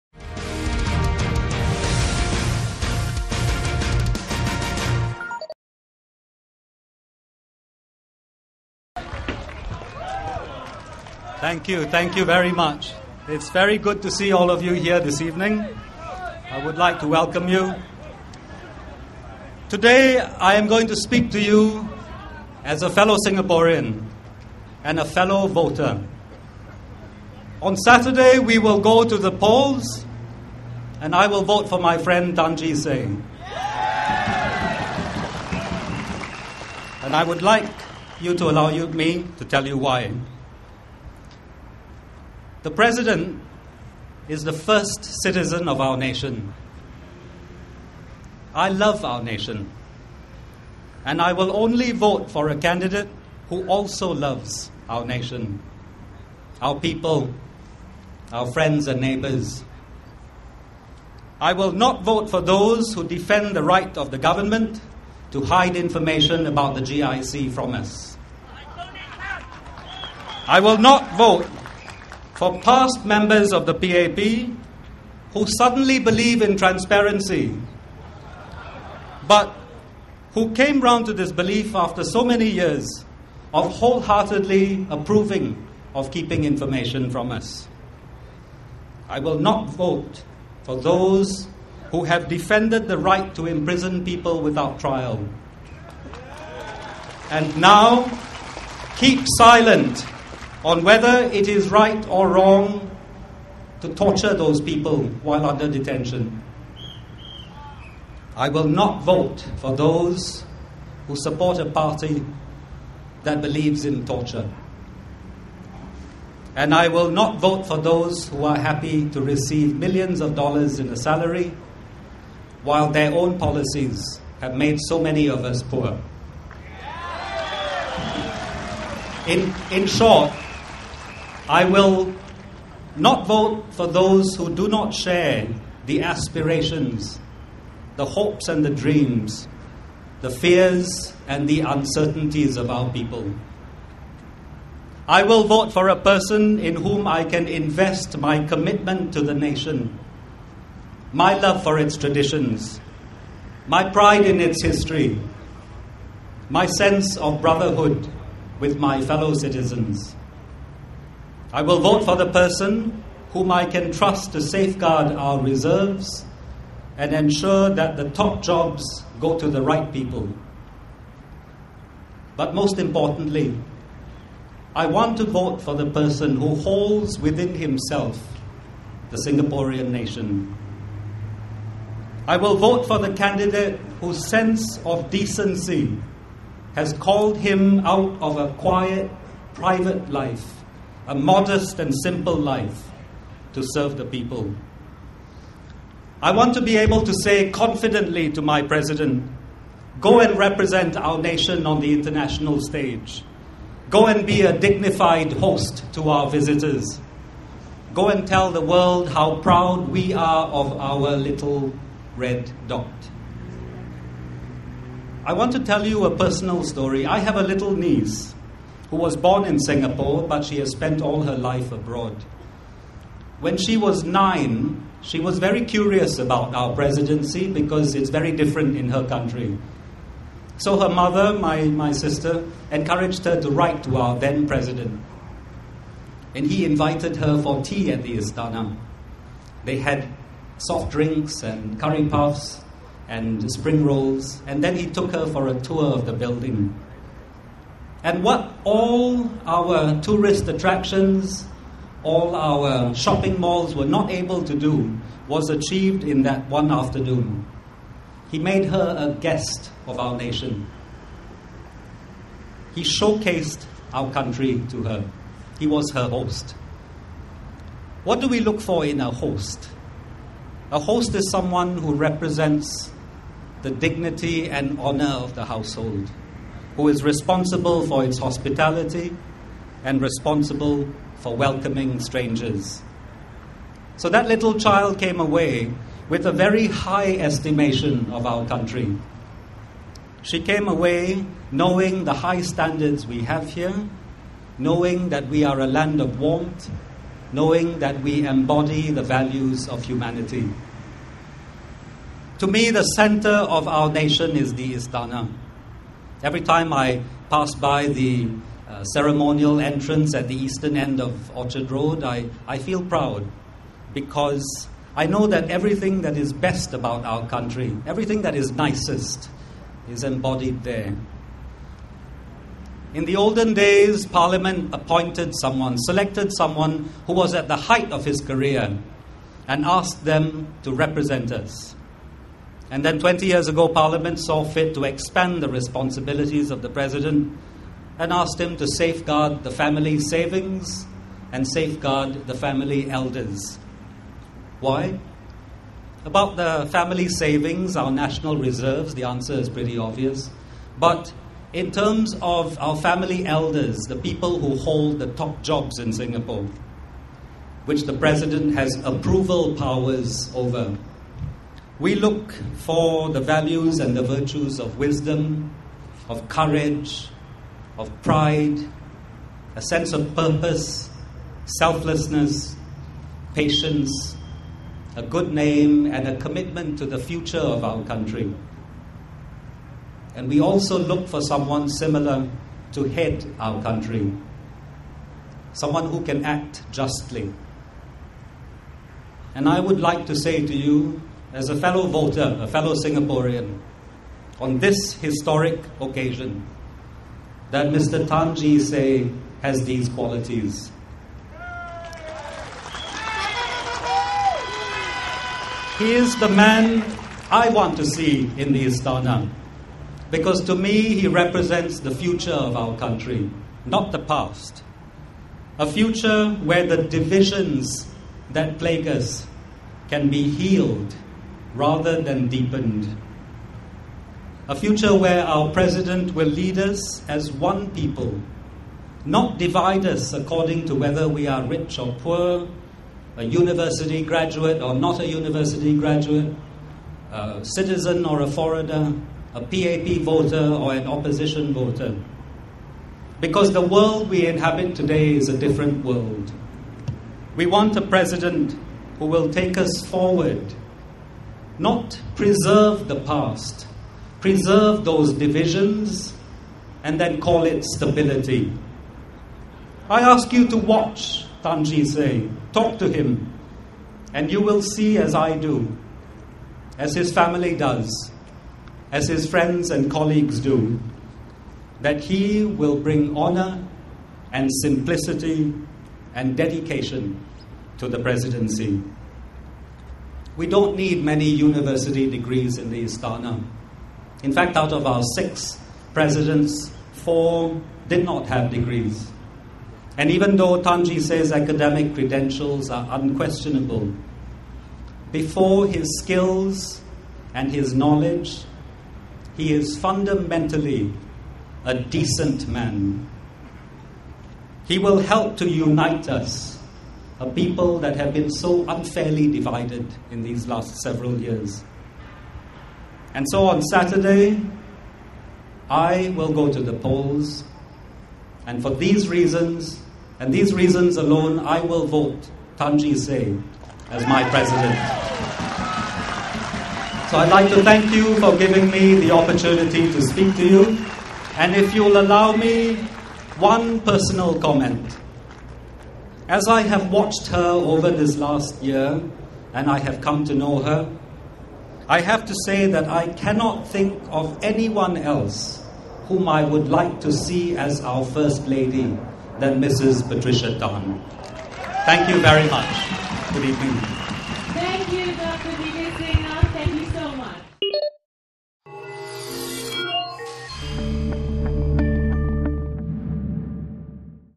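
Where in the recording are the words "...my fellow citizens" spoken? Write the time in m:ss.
2:38.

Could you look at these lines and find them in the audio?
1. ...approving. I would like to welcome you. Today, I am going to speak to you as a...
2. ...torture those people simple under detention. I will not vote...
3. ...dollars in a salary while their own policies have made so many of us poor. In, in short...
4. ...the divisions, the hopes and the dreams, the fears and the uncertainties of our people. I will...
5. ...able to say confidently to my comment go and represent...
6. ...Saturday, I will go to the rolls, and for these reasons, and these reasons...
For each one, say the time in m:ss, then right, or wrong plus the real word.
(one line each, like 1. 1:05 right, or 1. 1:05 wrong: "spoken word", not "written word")
1. 0:15 wrong: "evening", not "approving"
2. 1:43 wrong: "while", not "simple"
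3. 2:00 right
4. 2:15 wrong: "aspirations", not "divisions"
5. 3:16 wrong: "president", not "comment"
6. 8:33 wrong: "polls", not "rolls".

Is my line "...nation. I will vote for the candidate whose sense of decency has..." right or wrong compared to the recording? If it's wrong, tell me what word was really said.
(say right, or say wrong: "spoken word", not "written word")
right.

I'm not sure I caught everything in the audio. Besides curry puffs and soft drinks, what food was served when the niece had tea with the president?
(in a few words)
spring rolls.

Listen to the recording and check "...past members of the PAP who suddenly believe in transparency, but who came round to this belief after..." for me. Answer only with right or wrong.
right.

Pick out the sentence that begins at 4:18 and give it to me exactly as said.
He made her a guest of our nation.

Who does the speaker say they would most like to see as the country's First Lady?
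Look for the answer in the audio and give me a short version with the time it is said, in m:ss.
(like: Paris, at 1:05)
Patricia Tan, at 9:10.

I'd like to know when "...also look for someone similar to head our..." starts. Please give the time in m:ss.
6:20.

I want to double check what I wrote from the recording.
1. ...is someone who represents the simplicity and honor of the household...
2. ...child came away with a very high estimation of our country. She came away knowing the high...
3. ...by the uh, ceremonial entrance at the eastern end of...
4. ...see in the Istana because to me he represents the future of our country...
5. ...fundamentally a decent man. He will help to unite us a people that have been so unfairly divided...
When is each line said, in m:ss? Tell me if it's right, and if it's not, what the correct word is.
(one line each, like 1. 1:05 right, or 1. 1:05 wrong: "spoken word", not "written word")
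1. 4:31 wrong: "dignity", not "simplicity"
2. 4:44 right
3. 5:07 right
4. 6:47 right
5. 8:19 right.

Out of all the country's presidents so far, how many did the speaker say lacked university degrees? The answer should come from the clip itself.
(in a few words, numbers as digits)
4.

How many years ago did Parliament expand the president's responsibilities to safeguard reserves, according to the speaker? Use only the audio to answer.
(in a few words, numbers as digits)
20.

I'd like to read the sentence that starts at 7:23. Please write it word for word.
Because the world we inhabit today is a different world.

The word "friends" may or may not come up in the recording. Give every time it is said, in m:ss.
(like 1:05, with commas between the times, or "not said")
0:31, 0:58, 7:49.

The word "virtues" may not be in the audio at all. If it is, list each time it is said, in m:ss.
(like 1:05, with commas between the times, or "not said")
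6:04.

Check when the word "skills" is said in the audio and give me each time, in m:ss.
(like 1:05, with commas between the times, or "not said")
8:15.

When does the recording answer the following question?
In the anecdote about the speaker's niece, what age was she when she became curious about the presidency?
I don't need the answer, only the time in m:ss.
3:44.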